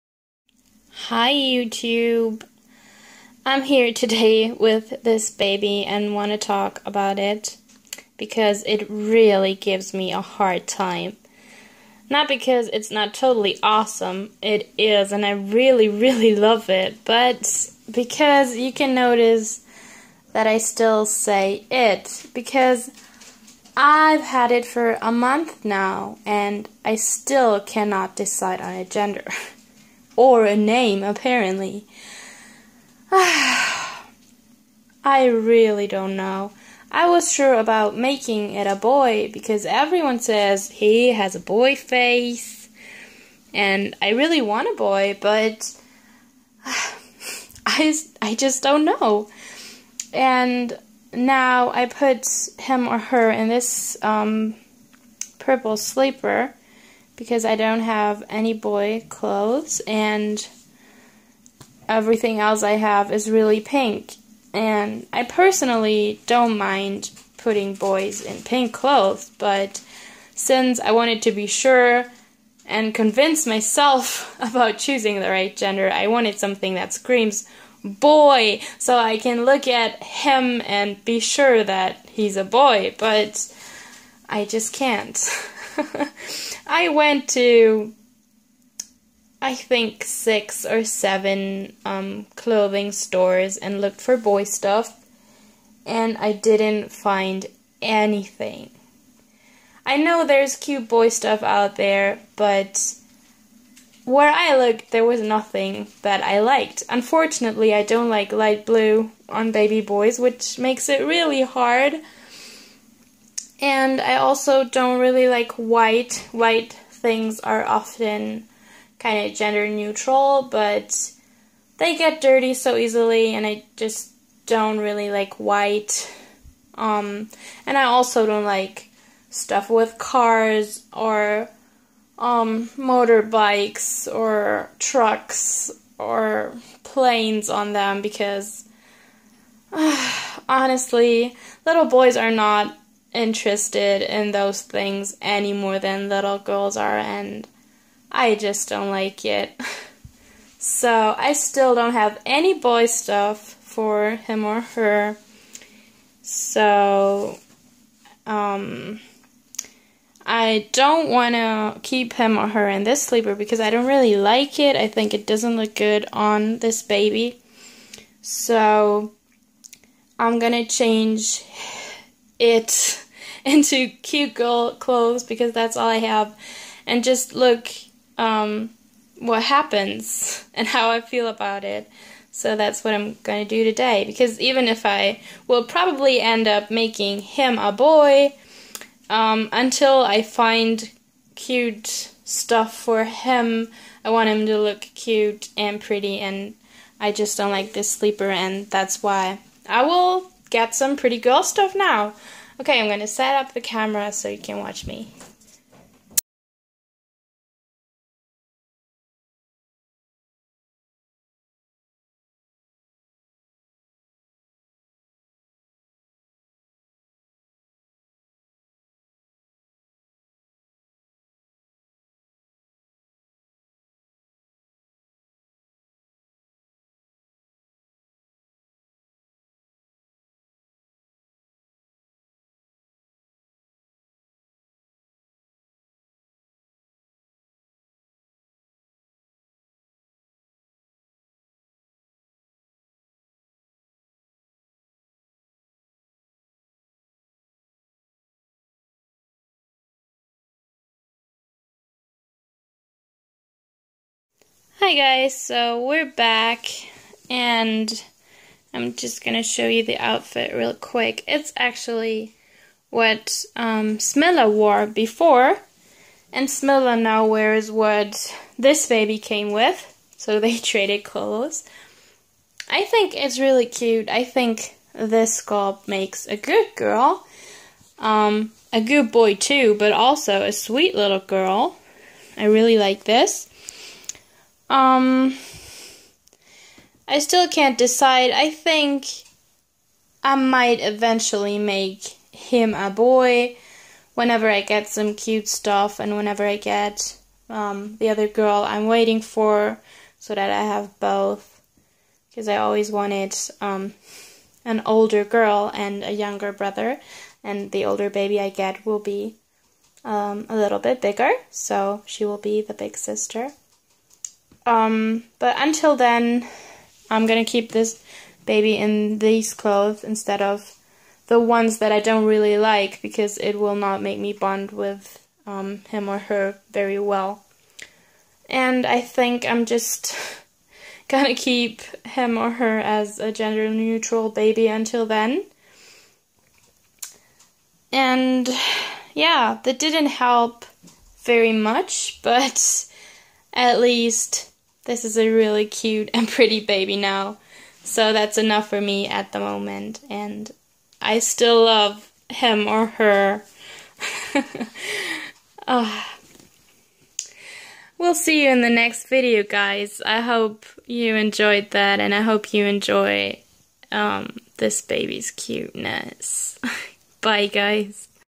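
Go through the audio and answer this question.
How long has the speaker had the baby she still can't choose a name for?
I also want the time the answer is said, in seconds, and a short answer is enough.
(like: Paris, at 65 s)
a month, at 25 s.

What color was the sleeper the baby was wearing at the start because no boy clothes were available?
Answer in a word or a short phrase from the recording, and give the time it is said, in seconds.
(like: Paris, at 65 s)
purple, at 55 s.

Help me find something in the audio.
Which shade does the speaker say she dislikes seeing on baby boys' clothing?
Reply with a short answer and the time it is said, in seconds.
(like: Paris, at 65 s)
light blue, at 108 s.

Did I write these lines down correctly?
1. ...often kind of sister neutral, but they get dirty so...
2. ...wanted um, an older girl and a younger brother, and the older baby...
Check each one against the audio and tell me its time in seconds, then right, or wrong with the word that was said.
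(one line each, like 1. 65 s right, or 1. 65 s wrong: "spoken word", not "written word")
1. 117 s wrong: "gender", not "sister"
2. 302 s right.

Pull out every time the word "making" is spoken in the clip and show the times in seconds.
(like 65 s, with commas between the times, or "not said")
37 s, 186 s.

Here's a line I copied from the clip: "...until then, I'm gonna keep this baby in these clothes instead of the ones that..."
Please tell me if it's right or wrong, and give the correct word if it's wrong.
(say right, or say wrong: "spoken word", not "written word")
right.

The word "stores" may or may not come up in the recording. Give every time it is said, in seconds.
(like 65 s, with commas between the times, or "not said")
92 s.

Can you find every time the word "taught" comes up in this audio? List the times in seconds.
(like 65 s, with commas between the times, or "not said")
not said.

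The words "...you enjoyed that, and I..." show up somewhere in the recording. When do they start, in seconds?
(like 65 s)
360 s.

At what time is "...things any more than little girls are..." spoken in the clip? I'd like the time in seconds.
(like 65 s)
144 s.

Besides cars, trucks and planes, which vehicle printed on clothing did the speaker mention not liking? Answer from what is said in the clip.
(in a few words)
motorbikes.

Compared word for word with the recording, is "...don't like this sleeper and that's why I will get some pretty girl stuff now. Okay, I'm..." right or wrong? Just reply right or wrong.
right.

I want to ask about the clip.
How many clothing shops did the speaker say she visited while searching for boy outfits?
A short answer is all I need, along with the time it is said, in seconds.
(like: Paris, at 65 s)
6 or 7, at 90 s.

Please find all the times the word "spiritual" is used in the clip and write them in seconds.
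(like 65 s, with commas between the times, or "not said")
not said.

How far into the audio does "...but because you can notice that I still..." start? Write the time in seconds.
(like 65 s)
17 s.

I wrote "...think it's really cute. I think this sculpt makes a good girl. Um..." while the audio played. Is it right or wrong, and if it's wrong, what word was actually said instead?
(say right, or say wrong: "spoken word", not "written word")
right.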